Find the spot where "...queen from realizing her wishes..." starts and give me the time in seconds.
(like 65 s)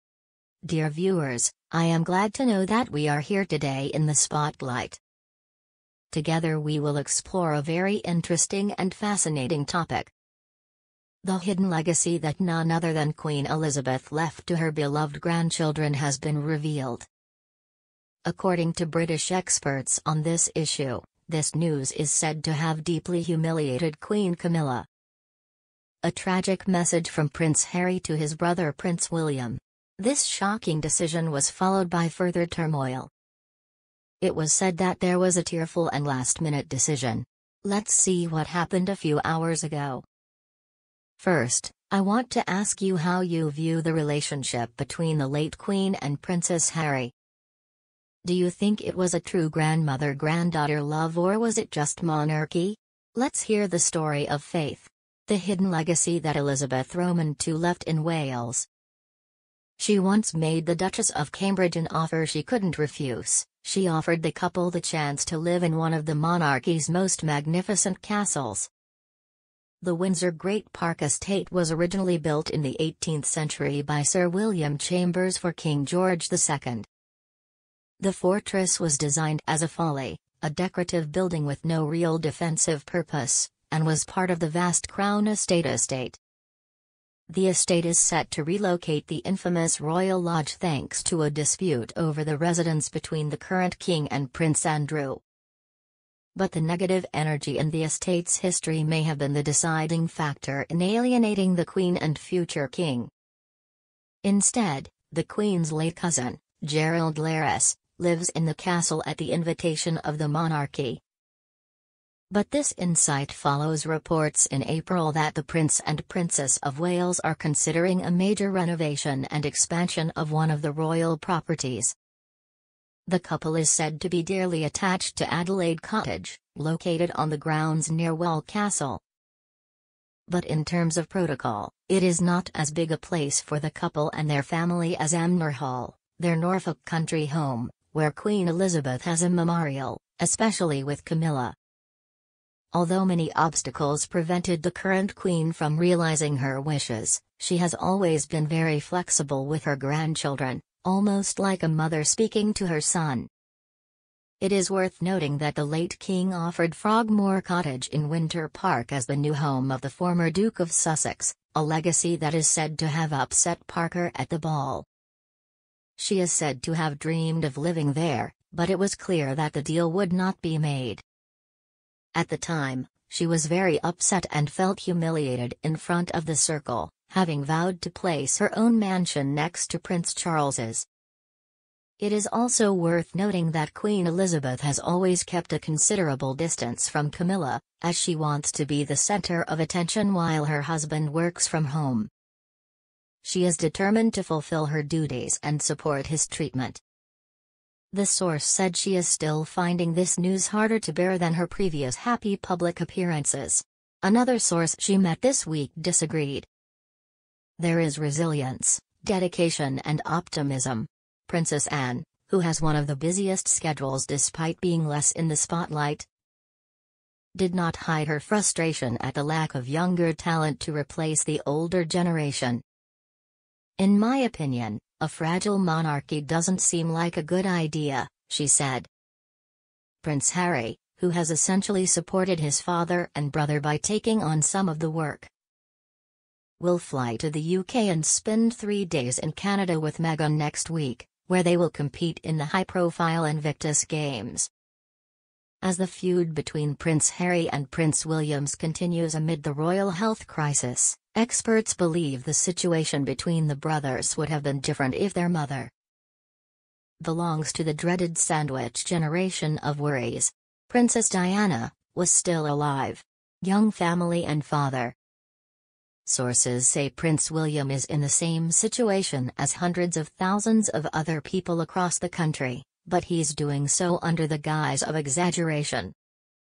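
145 s.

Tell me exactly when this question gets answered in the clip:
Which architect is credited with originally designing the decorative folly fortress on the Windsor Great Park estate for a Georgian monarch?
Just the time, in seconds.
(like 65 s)
74 s.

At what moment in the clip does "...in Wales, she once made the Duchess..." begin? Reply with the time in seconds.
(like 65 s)
57 s.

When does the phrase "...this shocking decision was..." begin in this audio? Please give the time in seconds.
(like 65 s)
30 s.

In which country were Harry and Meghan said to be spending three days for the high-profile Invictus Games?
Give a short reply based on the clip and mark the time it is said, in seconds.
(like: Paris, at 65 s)
Canada, at 239 s.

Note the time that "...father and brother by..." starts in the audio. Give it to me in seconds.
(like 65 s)
232 s.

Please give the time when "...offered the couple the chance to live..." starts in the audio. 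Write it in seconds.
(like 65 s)
63 s.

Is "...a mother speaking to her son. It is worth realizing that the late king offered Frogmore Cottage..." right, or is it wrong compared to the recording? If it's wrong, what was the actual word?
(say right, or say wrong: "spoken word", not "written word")
wrong: "noting", not "realizing".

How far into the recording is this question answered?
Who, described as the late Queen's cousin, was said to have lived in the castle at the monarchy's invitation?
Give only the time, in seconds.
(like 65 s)
106 s.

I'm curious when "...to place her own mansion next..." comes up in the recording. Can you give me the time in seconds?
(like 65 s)
177 s.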